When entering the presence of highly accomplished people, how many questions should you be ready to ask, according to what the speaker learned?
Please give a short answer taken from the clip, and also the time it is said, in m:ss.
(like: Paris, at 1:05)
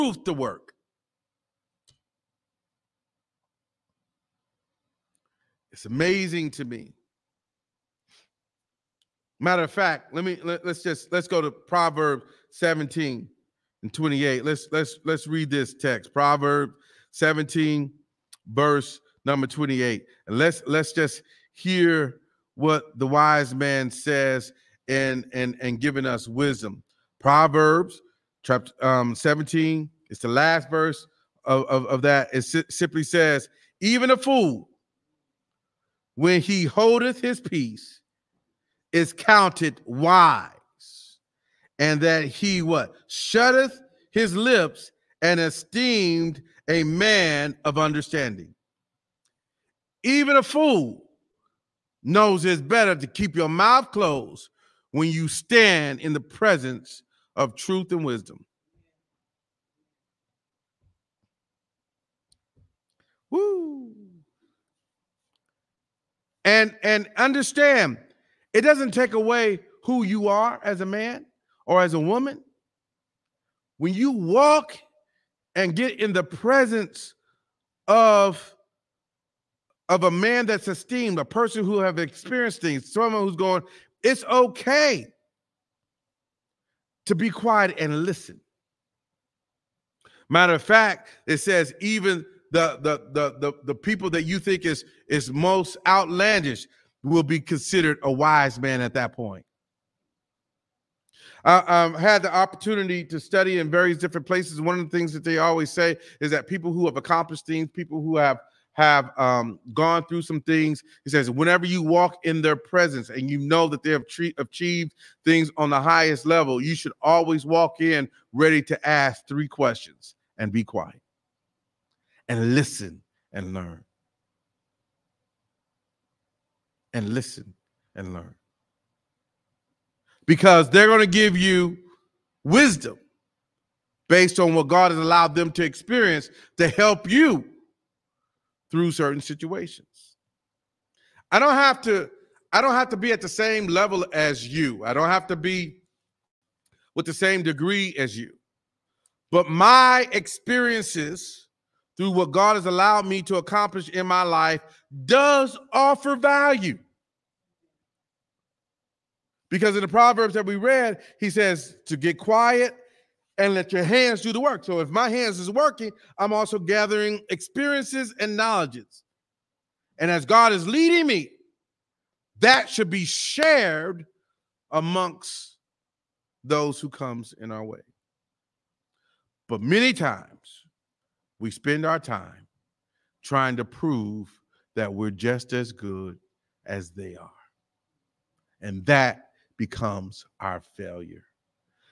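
3, at 1:59.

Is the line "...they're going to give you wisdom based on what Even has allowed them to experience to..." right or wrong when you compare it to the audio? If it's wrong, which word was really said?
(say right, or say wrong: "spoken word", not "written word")
wrong: "God", not "Even".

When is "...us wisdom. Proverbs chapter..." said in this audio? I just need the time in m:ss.
0:26.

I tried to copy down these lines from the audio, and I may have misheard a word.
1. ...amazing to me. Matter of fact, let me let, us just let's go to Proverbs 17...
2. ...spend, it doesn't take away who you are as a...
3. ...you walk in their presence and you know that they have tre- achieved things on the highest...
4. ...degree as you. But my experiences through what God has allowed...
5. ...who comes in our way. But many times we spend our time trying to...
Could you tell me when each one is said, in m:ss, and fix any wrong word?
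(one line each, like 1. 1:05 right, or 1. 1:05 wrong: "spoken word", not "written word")
1. 0:05 right
2. 1:07 wrong: "understand", not "spend"
3. 1:51 right
4. 2:27 right
5. 2:56 right.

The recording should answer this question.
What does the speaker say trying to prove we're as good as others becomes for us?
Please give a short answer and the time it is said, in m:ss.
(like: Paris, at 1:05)
our failure, at 3:10.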